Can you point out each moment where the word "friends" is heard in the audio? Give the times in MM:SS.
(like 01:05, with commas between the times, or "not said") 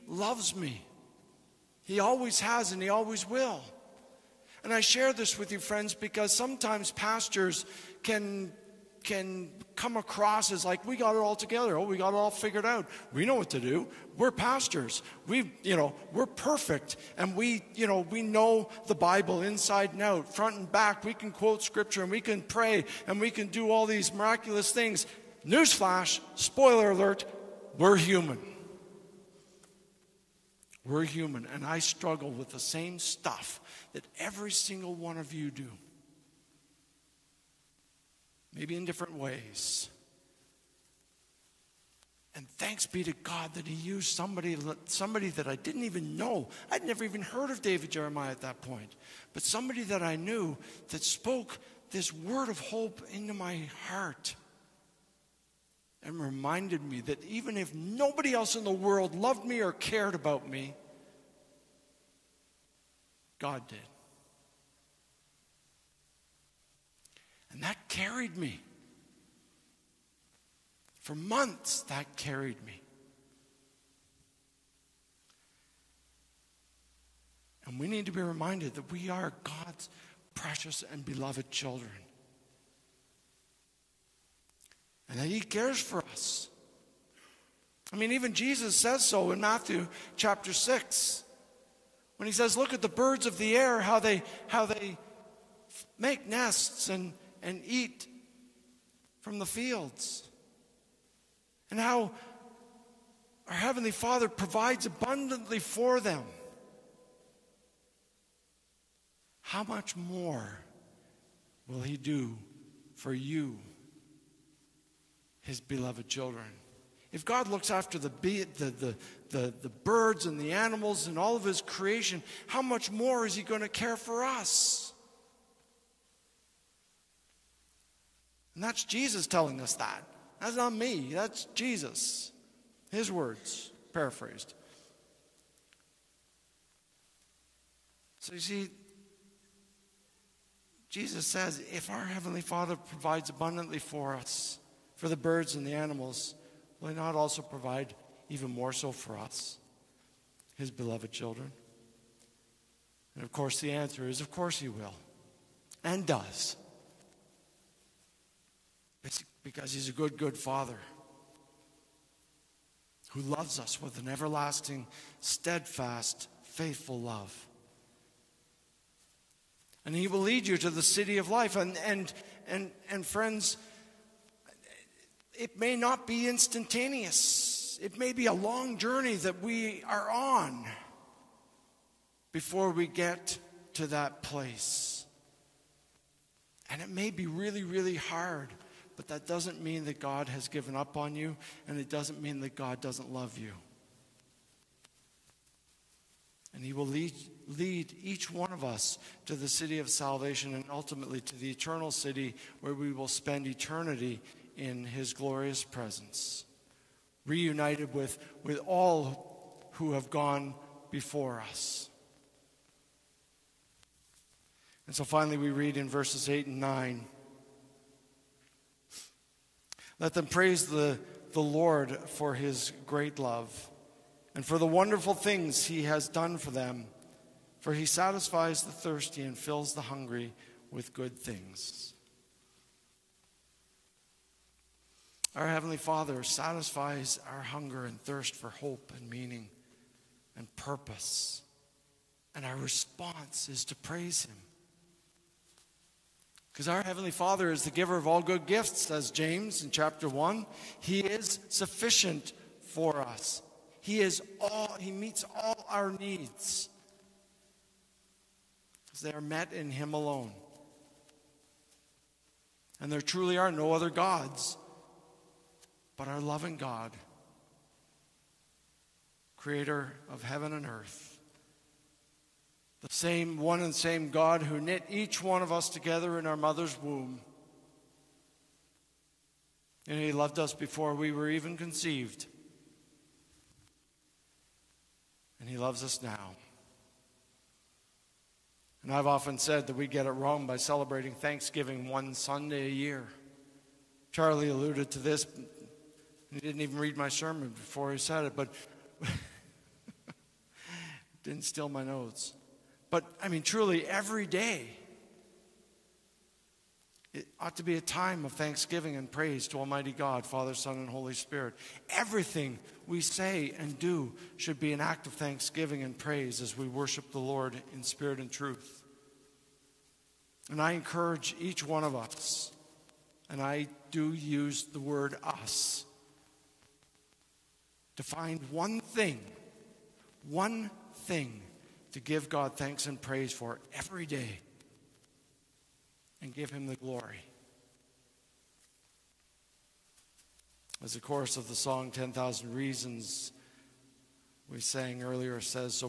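00:05, 02:53.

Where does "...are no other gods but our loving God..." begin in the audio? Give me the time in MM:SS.
04:23.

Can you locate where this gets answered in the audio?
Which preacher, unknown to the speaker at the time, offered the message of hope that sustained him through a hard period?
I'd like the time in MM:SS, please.
00:47.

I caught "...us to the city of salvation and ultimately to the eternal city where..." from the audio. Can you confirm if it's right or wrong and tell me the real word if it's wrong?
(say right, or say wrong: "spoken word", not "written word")
right.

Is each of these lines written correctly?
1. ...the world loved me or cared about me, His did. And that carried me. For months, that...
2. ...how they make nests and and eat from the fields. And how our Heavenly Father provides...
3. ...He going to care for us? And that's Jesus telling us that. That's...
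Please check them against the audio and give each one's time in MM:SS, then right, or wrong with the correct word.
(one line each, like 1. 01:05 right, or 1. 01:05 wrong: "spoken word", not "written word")
1. 00:58 wrong: "God", not "His"
2. 01:34 right
3. 02:03 right.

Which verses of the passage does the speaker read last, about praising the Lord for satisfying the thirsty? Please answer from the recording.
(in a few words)
8 and 9.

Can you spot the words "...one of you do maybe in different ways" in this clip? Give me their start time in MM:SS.
00:34.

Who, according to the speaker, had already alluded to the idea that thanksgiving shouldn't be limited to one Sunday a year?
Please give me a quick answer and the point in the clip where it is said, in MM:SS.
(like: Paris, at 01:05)
Charlie, at 04:54.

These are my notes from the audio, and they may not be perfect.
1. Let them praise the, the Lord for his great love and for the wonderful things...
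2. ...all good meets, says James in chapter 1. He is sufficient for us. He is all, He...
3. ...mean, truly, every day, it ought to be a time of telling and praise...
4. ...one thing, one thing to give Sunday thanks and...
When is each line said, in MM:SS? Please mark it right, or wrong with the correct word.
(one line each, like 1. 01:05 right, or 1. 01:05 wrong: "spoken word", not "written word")
1. 03:40 right
2. 04:08 wrong: "gifts", not "meets"
3. 05:03 wrong: "thanksgiving", not "telling"
4. 05:28 wrong: "God", not "Sunday".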